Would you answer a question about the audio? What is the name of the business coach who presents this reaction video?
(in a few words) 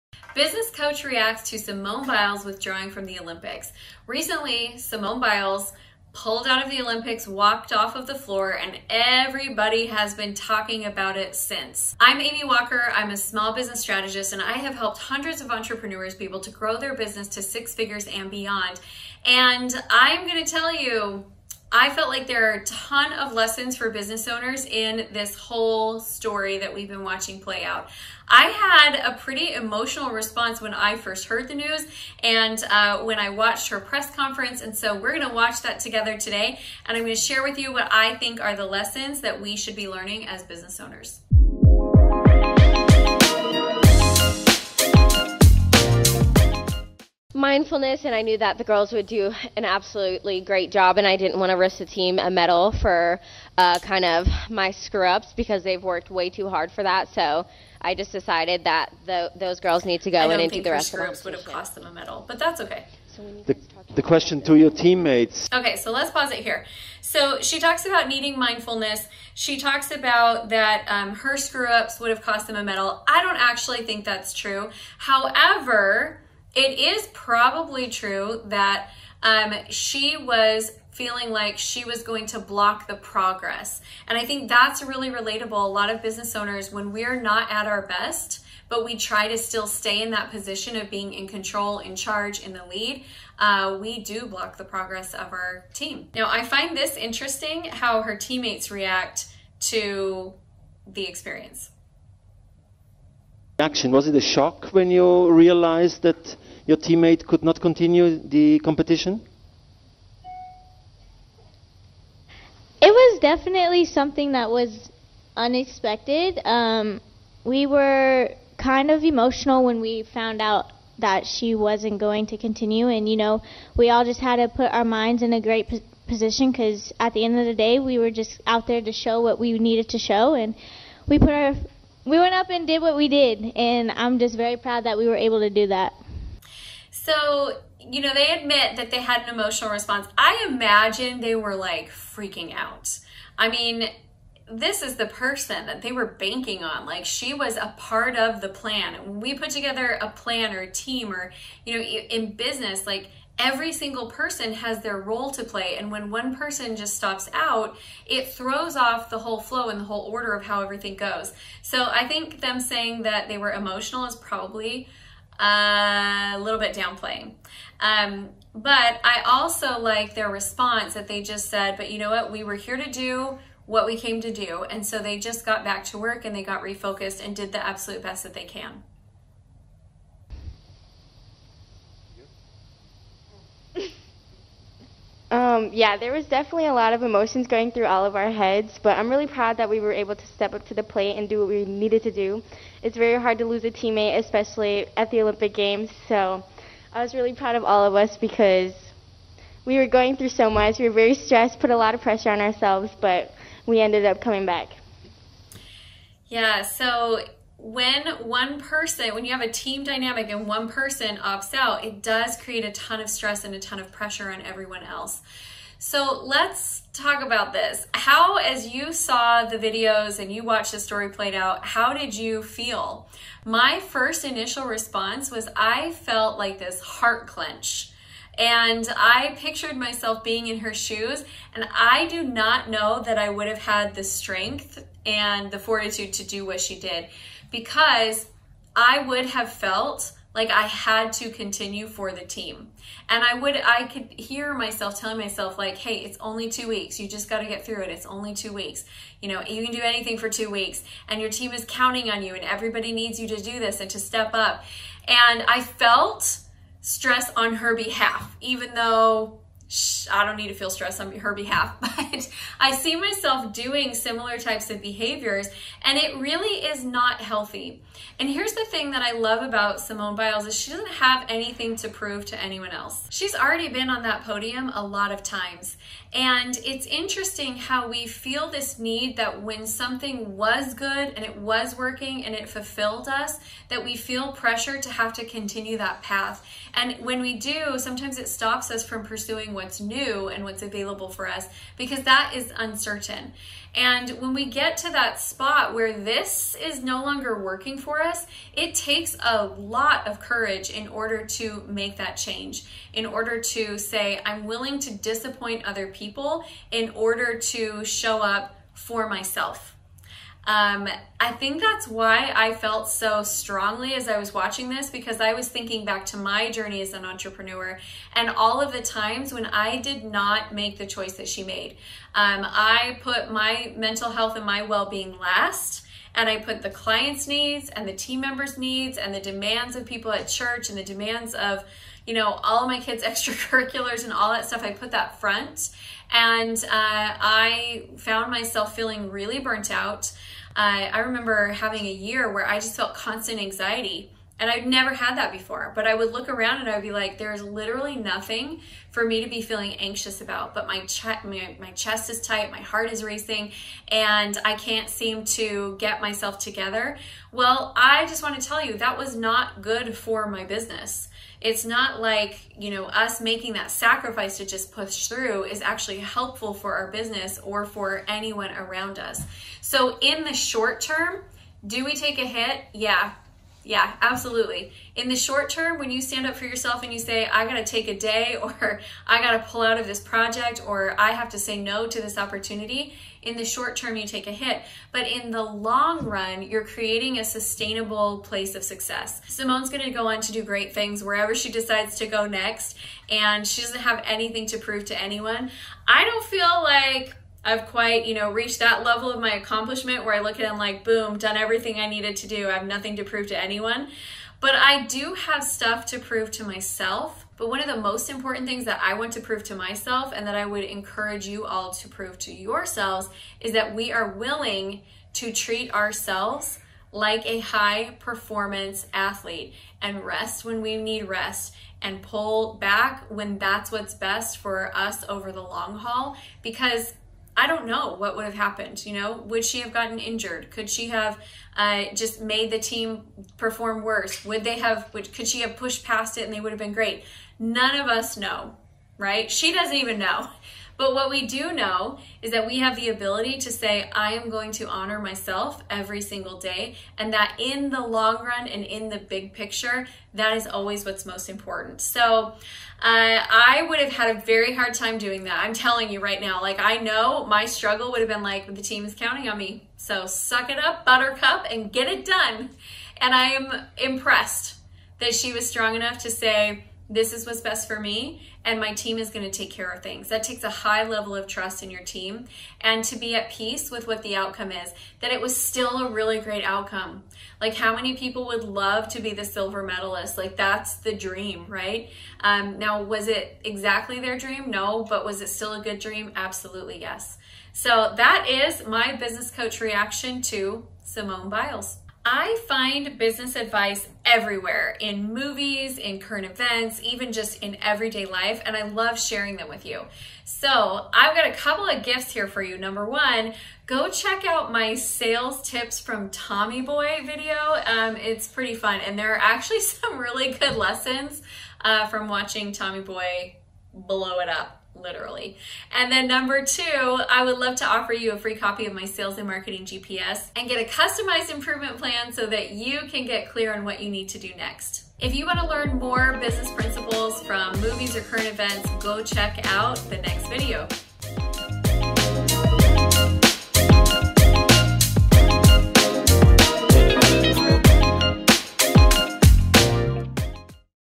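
Amy Walker.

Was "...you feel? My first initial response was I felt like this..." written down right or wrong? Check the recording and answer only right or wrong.
right.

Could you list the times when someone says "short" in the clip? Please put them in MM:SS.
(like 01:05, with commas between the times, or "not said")
06:10, 06:15, 06:23.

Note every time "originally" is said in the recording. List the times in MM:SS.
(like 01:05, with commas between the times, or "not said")
not said.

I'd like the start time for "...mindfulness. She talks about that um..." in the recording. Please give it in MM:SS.
01:08.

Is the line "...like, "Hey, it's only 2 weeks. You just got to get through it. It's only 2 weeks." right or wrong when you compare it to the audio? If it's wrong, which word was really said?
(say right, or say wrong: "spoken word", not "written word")
right.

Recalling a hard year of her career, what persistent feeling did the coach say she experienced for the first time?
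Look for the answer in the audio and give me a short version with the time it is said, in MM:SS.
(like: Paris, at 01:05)
constant anxiety, at 05:42.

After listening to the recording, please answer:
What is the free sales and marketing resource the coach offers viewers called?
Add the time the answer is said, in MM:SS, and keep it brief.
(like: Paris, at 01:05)
sales and marketing GPS, at 08:38.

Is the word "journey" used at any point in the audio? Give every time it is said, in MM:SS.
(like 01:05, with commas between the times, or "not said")
05:16.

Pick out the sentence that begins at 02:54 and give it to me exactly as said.
And so they just got back to work and they got refocused and did the absolute best that they can.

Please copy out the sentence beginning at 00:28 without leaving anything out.
I had a pretty emotional response when I first heard the news and uh, when I watched her press conference.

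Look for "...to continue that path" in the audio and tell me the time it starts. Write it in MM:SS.
04:45.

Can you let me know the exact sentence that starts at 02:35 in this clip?
And when one person just stops out, it throws off the whole flow and the whole order of how everything goes.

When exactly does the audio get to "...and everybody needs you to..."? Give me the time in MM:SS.
04:12.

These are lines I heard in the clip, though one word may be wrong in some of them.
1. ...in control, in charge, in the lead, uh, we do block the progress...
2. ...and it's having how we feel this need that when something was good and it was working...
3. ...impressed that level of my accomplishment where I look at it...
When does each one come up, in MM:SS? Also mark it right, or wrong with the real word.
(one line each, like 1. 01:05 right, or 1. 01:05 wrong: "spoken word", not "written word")
1. 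01:31 right
2. 04:36 wrong: "interesting", not "having"
3. 06:38 wrong: "reached", not "impressed".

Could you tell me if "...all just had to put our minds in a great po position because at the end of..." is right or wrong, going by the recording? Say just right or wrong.
right.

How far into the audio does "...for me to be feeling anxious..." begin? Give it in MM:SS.
05:48.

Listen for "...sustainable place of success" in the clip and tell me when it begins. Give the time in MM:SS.
06:27.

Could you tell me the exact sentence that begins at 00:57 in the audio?
So I just decided that the, those girls need to go in and do the rest of the competition.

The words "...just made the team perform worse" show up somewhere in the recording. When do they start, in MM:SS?
07:11.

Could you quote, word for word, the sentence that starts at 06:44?
But I do have stuff to prove to myself.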